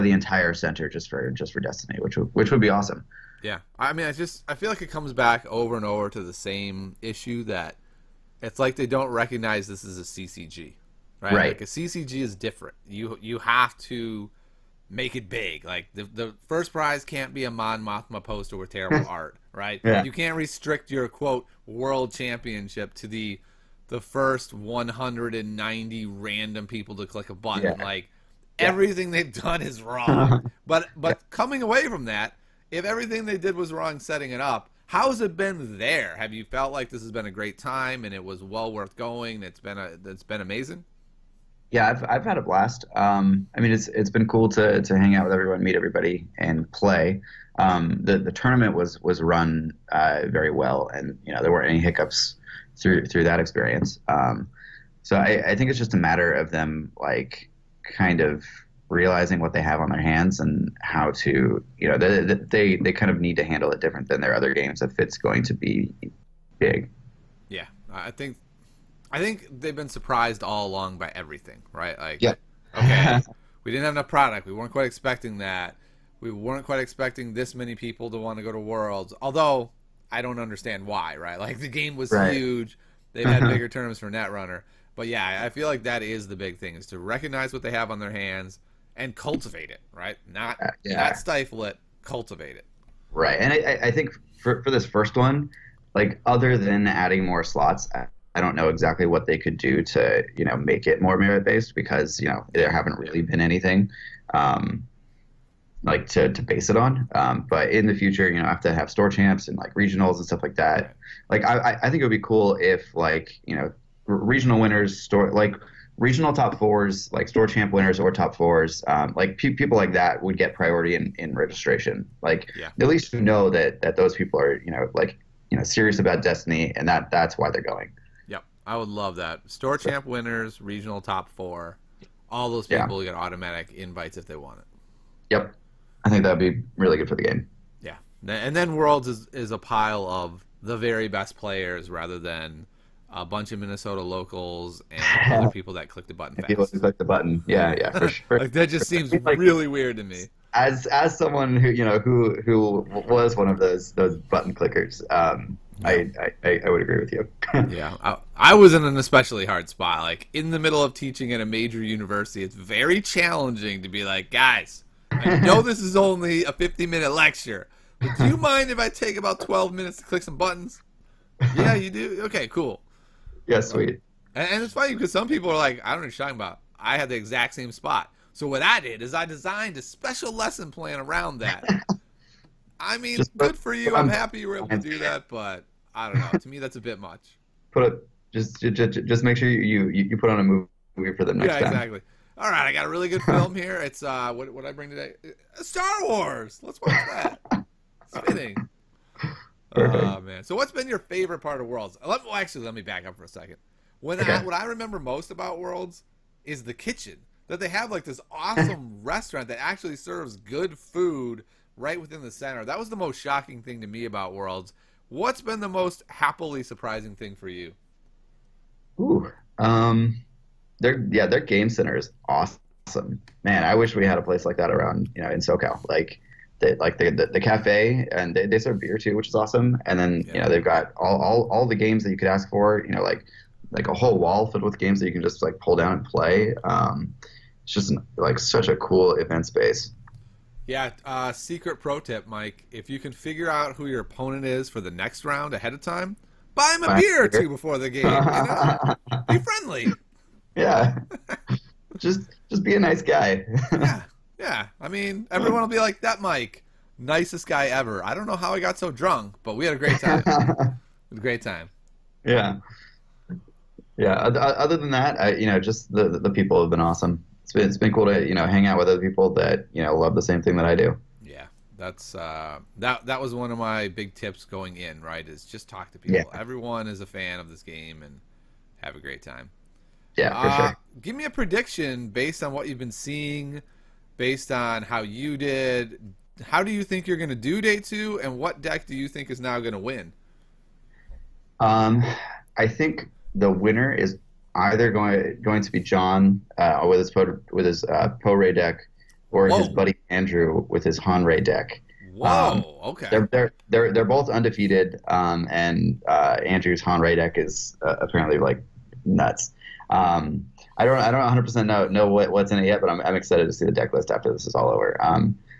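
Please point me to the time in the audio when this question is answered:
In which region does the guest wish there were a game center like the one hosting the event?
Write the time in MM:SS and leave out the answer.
03:45.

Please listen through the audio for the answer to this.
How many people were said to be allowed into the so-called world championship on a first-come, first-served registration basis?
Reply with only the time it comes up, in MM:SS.
00:24.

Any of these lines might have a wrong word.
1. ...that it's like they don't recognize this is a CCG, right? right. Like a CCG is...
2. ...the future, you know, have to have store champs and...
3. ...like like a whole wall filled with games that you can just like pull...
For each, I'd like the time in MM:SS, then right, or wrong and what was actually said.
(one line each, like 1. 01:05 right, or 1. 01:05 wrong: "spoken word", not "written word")
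1. 00:07 right
2. 01:47 right
3. 03:53 right.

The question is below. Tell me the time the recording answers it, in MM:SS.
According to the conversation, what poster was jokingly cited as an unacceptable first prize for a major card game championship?
00:17.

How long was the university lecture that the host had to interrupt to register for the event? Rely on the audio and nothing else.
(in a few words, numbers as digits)
50 minute.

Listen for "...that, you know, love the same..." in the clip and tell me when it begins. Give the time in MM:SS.
04:29.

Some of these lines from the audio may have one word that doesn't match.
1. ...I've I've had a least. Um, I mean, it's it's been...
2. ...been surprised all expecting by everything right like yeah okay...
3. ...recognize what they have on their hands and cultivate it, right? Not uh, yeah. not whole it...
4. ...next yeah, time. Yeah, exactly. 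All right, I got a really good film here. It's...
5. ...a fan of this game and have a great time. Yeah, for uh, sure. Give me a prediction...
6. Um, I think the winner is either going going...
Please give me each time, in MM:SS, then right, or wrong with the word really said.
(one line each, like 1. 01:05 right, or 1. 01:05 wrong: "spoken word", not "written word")
1. 00:41 wrong: "blast", not "least"
2. 01:09 wrong: "along", not "expecting"
3. 01:26 wrong: "stifle", not "whole"
4. 03:11 right
5. 04:37 right
6. 04:51 right.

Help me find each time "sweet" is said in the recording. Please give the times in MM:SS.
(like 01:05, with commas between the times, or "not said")
02:53.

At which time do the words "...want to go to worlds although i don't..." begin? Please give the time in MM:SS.
01:18.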